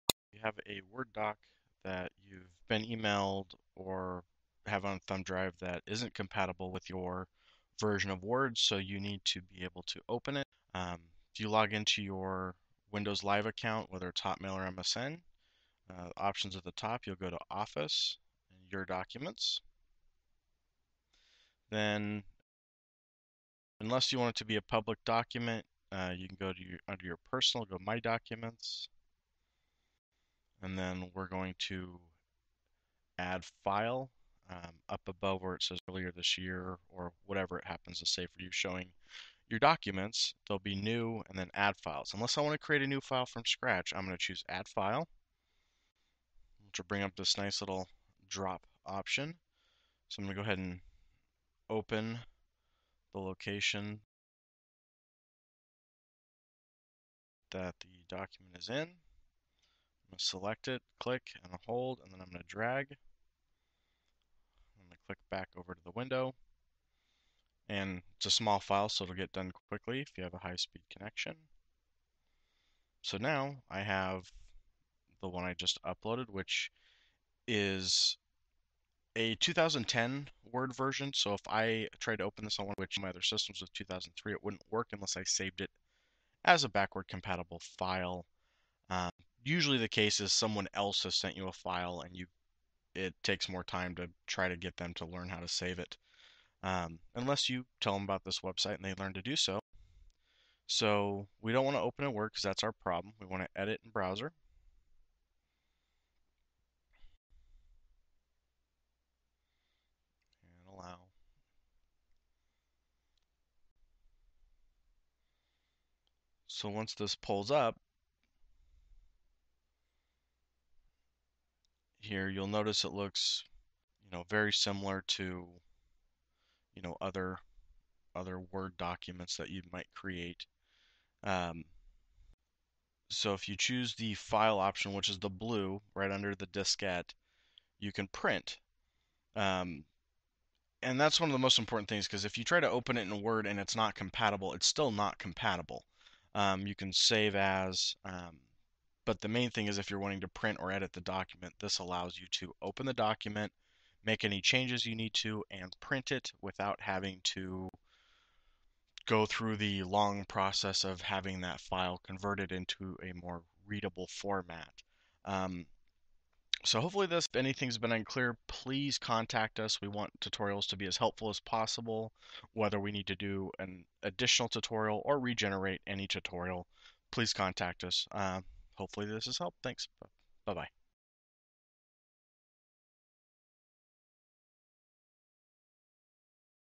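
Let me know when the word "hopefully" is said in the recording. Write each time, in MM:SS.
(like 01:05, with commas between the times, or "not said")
02:46, 02:58.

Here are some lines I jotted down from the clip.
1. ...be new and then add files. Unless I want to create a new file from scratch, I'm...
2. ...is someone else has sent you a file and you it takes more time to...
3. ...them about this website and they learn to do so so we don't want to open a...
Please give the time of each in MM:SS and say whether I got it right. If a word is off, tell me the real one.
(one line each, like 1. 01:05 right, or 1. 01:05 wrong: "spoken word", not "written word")
1. 00:40 right
2. 01:30 right
3. 01:37 right.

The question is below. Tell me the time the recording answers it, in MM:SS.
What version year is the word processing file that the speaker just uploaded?
01:19.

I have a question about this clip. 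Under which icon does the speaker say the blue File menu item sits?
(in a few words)
the diskette.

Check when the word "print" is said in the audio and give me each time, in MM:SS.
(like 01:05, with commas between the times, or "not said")
02:18, 02:30, 02:35.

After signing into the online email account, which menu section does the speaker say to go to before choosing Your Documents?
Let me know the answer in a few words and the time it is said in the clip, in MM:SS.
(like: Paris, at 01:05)
Office, at 00:17.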